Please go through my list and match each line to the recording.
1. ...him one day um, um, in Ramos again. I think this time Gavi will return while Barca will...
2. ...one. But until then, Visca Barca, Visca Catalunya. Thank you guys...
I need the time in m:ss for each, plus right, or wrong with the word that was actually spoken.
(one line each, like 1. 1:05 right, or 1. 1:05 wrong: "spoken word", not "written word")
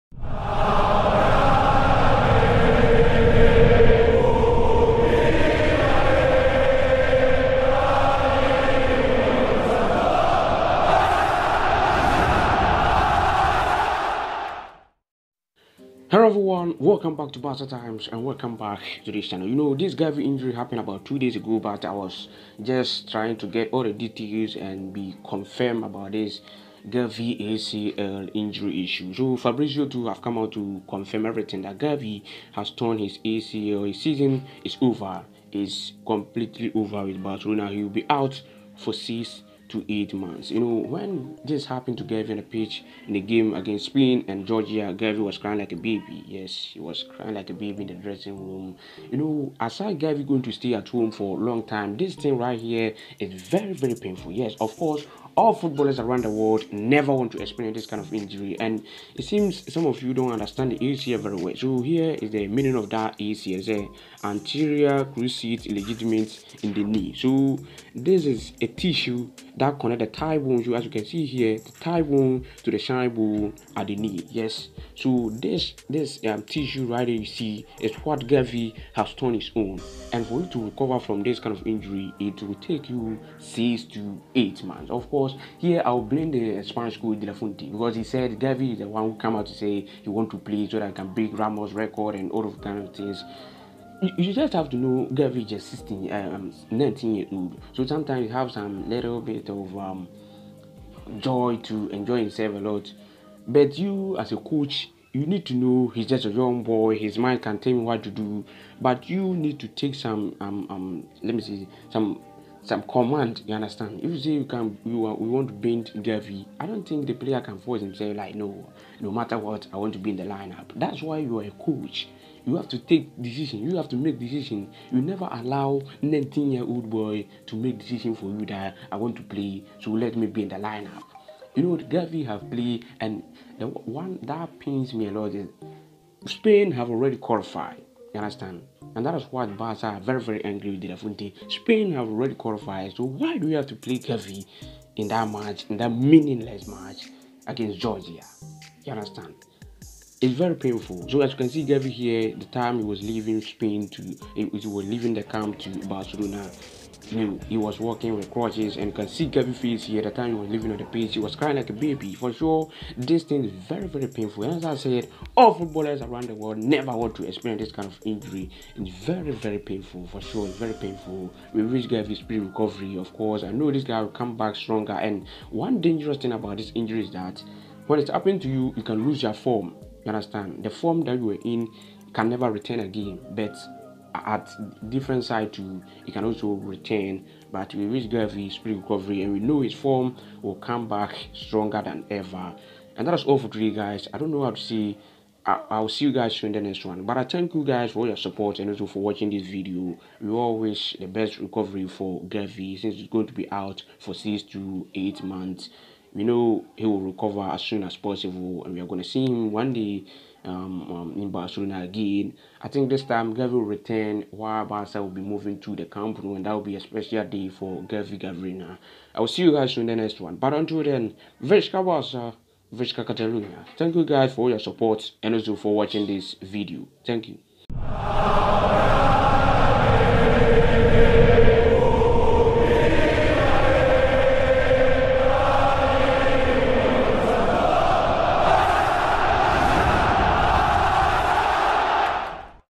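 1. 3:29 wrong: "Barcelona", not "Ramos"
2. 3:40 right.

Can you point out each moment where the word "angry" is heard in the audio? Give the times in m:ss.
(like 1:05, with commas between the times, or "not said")
2:20.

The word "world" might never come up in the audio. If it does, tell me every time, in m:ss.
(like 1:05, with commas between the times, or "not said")
0:56, 2:46.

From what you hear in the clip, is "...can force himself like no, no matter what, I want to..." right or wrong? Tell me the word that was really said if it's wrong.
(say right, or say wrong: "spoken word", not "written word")
right.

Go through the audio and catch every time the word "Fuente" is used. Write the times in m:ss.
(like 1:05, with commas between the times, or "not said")
1:27, 2:20.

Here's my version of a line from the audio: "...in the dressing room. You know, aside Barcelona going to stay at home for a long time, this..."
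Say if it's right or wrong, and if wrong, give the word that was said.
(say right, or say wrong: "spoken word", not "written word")
wrong: "Gavi", not "Barcelona".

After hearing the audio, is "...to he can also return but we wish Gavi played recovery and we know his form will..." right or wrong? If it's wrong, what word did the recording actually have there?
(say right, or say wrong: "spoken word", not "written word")
wrong: "speed", not "played".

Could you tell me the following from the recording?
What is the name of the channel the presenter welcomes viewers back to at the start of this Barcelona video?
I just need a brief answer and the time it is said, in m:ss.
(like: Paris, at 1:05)
Barca Times, at 0:17.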